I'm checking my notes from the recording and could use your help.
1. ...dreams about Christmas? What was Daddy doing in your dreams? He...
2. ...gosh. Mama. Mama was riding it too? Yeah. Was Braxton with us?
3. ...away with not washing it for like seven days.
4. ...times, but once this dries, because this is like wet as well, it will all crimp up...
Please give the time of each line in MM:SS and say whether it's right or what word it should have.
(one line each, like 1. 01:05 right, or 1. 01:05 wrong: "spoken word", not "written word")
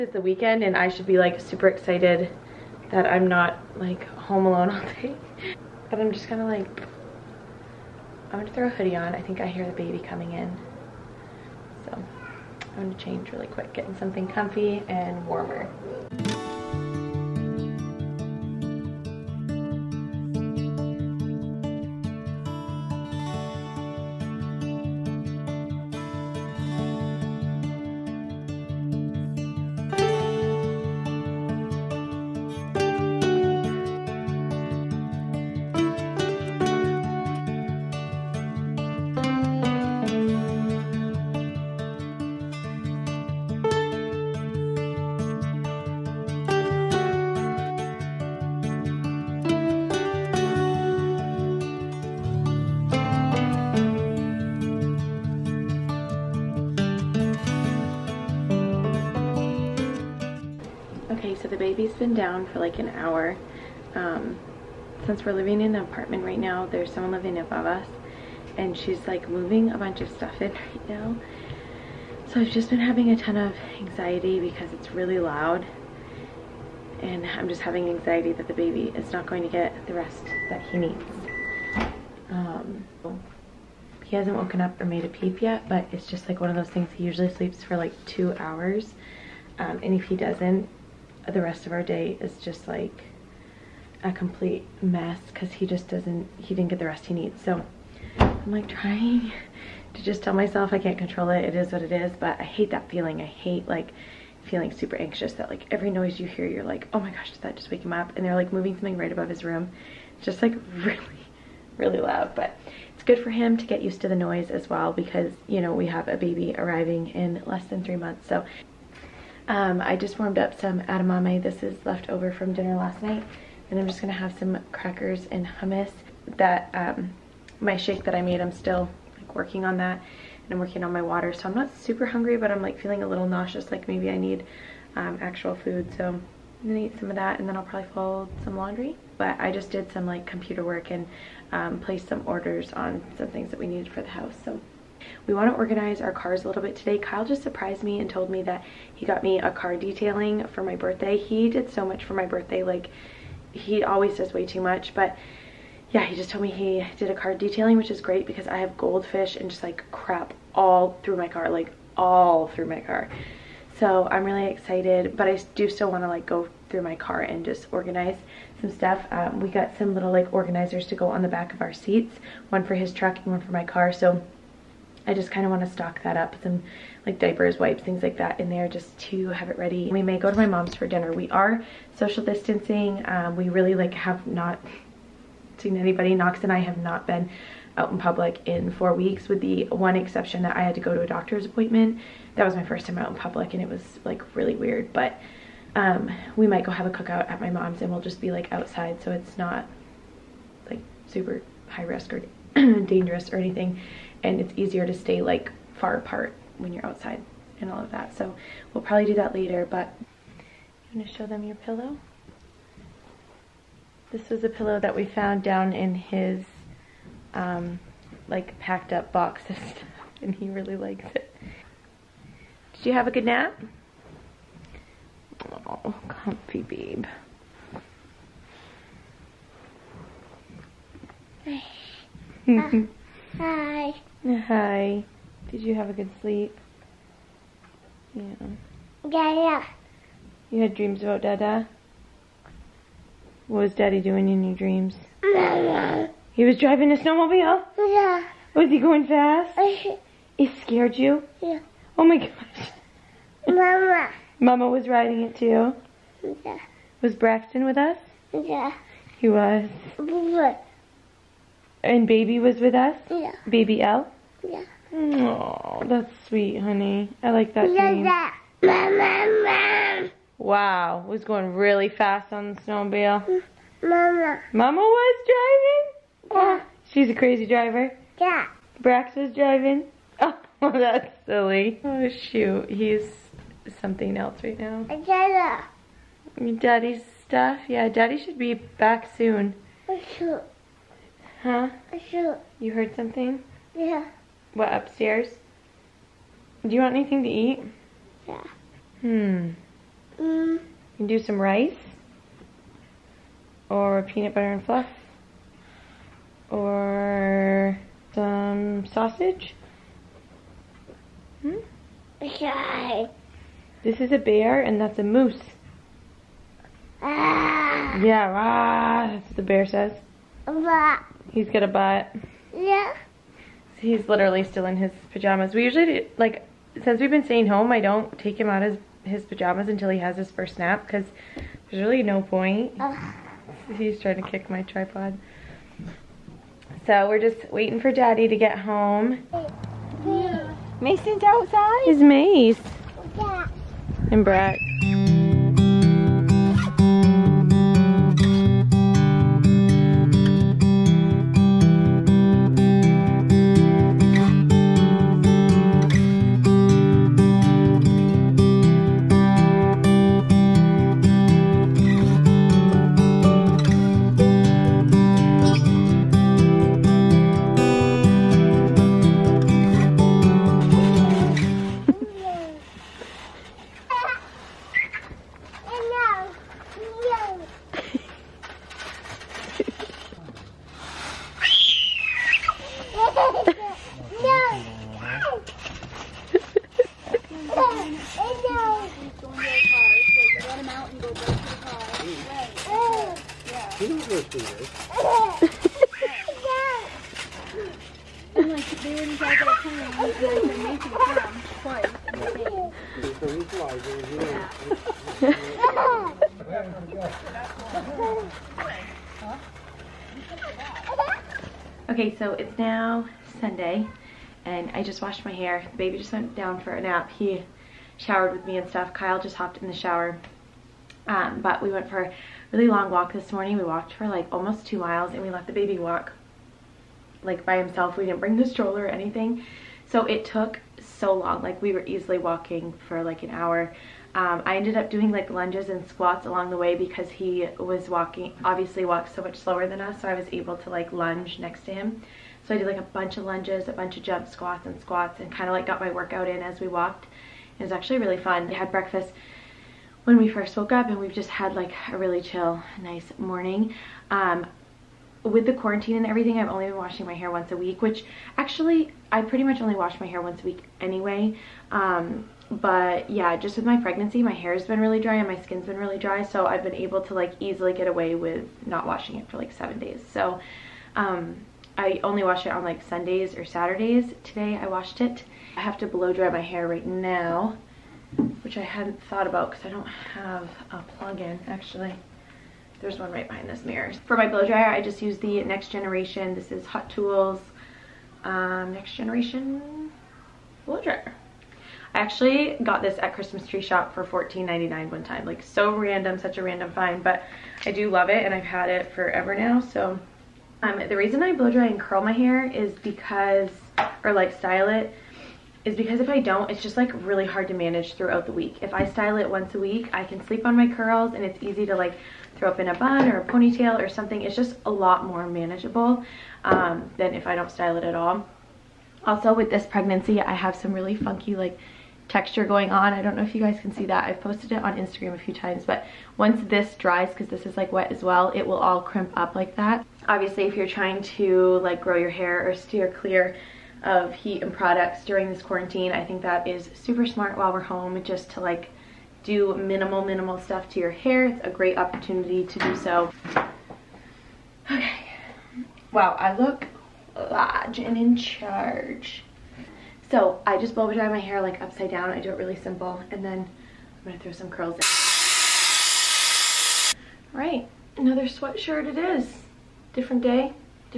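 1. 04:00 wrong: "Dada", not "Christmas"
2. 04:12 right
3. 07:47 right
4. 08:45 right.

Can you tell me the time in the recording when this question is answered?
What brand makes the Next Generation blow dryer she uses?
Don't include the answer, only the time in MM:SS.
08:06.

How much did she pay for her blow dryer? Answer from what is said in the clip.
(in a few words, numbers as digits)
$14.99.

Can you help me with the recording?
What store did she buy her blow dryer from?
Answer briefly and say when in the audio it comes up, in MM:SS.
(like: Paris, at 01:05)
Christmas Tree Shop, at 08:13.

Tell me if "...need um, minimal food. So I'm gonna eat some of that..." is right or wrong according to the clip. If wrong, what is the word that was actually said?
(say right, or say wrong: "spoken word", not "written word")
wrong: "actual", not "minimal".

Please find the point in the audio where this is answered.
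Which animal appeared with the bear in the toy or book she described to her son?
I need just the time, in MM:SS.
05:15.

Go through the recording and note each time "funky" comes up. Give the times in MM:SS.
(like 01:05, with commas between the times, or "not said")
08:40.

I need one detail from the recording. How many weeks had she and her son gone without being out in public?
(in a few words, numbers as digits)
4.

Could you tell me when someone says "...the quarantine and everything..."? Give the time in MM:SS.
07:35.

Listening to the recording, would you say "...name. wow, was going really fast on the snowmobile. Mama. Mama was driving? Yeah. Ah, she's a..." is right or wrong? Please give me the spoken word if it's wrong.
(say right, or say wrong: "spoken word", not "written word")
right.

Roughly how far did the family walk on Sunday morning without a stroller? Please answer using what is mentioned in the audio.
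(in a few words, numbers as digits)
Almost 2 miles.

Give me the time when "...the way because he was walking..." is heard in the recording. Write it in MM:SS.
07:16.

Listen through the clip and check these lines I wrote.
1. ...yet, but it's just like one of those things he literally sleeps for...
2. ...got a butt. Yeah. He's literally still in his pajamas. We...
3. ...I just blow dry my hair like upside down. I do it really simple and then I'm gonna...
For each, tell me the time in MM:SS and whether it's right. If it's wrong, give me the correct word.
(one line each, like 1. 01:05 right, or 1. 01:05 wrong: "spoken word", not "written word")
1. 01:25 wrong: "usually", not "literally"
2. 05:21 right
3. 09:10 right.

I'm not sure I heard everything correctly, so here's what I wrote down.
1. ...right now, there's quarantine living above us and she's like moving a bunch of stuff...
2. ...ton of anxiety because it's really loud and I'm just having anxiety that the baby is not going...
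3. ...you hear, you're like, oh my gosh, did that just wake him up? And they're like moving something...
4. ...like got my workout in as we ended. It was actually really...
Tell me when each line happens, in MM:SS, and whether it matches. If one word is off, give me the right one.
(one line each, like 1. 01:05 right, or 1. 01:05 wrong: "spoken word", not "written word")
1. 01:06 wrong: "someone", not "quarantine"
2. 01:13 right
3. 01:46 right
4. 07:25 wrong: "walked", not "ended".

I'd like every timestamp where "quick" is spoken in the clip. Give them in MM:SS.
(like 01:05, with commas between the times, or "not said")
00:13.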